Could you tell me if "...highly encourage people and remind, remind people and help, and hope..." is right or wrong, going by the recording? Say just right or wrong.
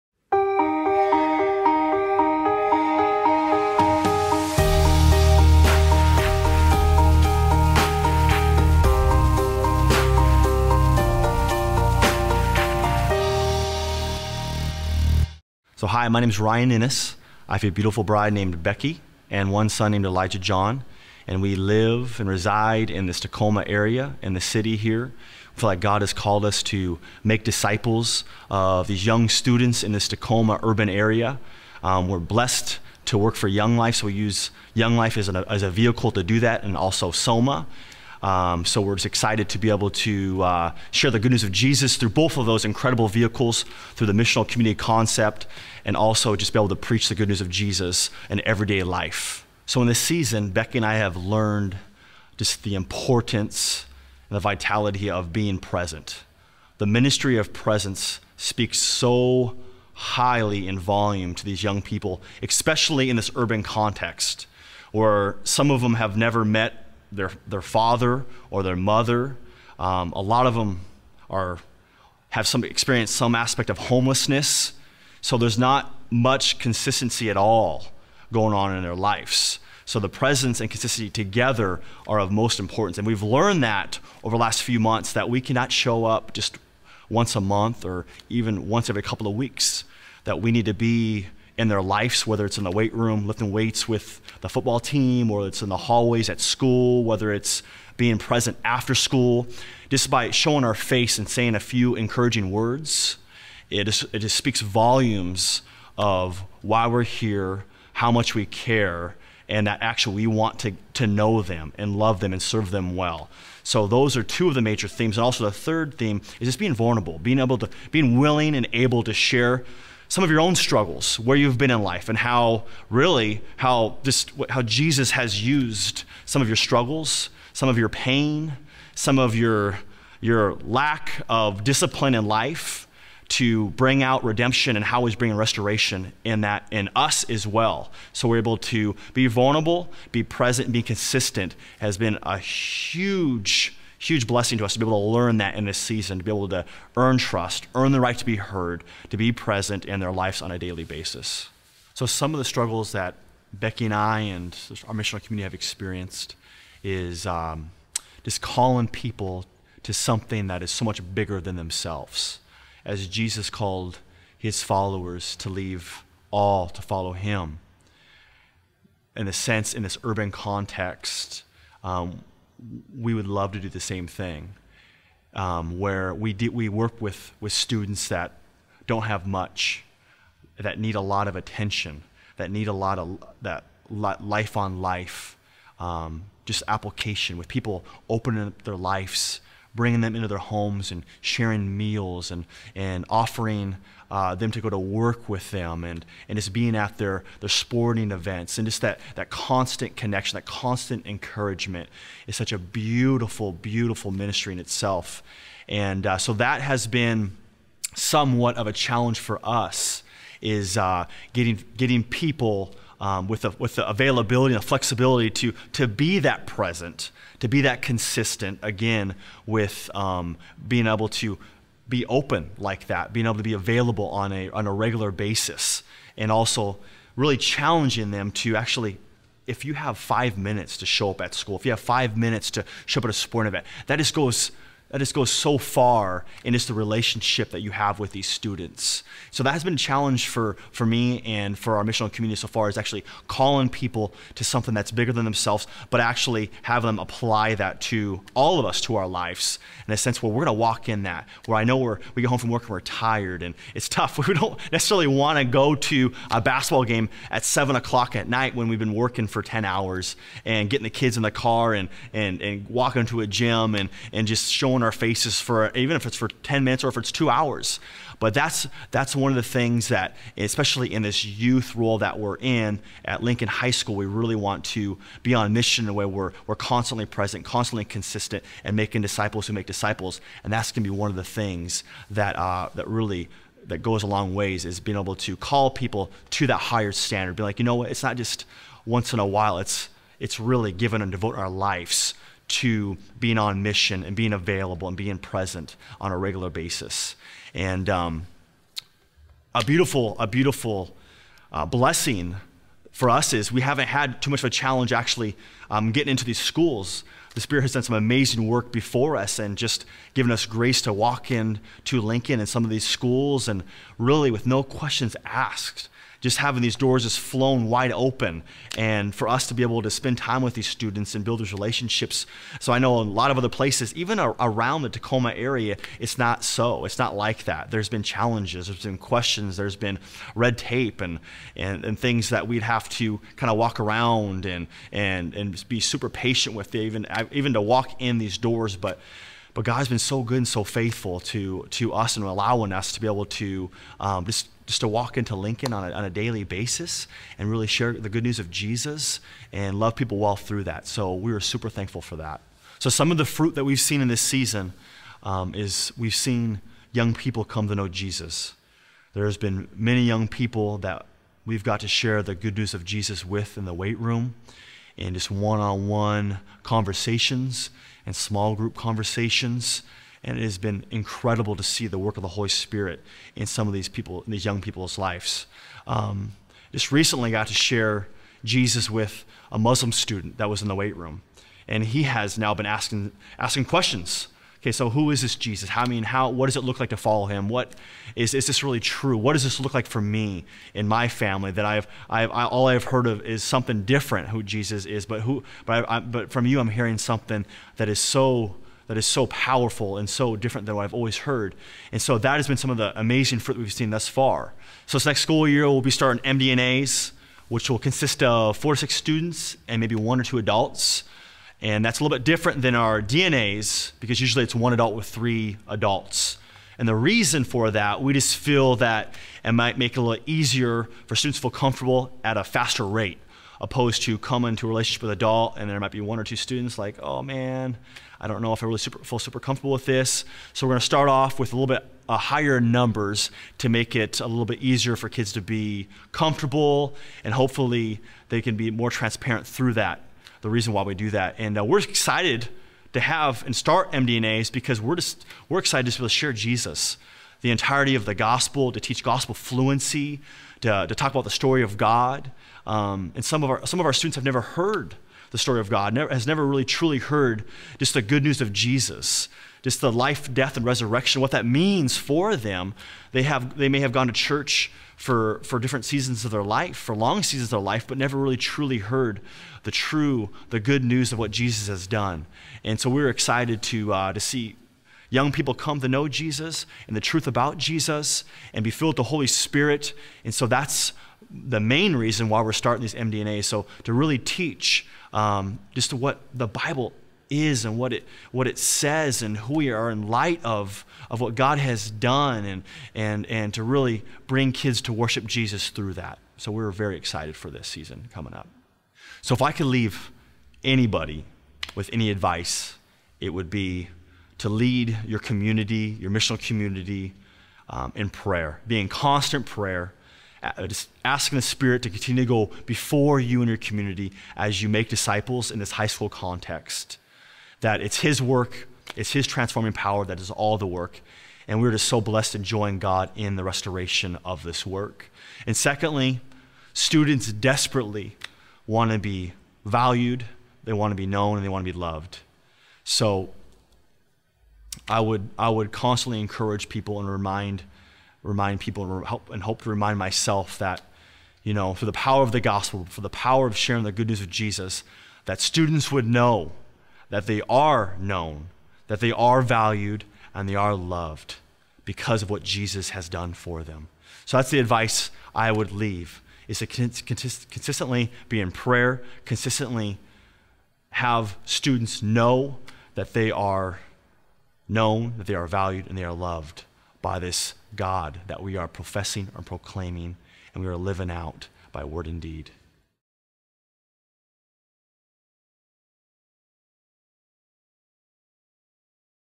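wrong.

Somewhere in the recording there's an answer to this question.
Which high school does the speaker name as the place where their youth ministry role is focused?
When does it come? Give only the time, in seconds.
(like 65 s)
273 s.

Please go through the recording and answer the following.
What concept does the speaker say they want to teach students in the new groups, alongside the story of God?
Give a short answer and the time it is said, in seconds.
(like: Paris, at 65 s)
gospel fluency, at 449 s.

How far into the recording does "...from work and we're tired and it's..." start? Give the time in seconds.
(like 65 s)
252 s.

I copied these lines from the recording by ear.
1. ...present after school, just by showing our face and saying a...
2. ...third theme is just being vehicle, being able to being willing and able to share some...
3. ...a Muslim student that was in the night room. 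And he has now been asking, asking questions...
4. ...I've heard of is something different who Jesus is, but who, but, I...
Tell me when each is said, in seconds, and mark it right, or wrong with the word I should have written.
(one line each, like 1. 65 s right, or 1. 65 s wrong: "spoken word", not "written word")
1. 98 s right
2. 115 s wrong: "vulnerable", not "vehicle"
3. 379 s wrong: "weight", not "night"
4. 392 s right.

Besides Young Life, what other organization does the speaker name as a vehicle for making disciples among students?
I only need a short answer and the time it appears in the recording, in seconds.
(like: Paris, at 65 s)
SOMA, at 37 s.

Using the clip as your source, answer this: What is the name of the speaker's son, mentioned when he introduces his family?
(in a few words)
Elijah John.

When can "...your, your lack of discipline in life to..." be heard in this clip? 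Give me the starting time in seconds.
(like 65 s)
129 s.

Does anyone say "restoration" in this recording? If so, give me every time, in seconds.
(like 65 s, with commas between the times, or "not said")
135 s, 523 s.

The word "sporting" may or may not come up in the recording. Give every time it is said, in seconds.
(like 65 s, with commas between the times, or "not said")
197 s, 233 s.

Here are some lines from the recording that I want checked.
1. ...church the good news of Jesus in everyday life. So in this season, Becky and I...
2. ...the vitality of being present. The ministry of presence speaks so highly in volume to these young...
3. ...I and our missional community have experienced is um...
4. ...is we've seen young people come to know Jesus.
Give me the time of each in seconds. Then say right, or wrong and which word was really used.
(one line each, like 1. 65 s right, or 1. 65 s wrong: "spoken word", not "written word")
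1. 46 s wrong: "preach", not "church"
2. 54 s right
3. 153 s right
4. 355 s right.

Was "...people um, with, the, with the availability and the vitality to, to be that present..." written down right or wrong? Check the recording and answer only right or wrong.
wrong.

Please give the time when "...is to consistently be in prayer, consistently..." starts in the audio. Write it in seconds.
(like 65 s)
556 s.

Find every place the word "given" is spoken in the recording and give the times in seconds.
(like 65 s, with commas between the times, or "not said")
290 s, 310 s.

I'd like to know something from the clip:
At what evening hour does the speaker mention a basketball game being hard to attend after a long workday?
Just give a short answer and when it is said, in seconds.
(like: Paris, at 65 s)
7 o'clock, at 257 s.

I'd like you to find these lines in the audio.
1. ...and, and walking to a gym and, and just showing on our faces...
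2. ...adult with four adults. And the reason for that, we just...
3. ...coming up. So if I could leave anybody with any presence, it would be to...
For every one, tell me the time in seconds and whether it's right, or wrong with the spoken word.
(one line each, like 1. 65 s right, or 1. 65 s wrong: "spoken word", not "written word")
1. 262 s right
2. 414 s wrong: "three", not "four"
3. 498 s wrong: "advice", not "presence".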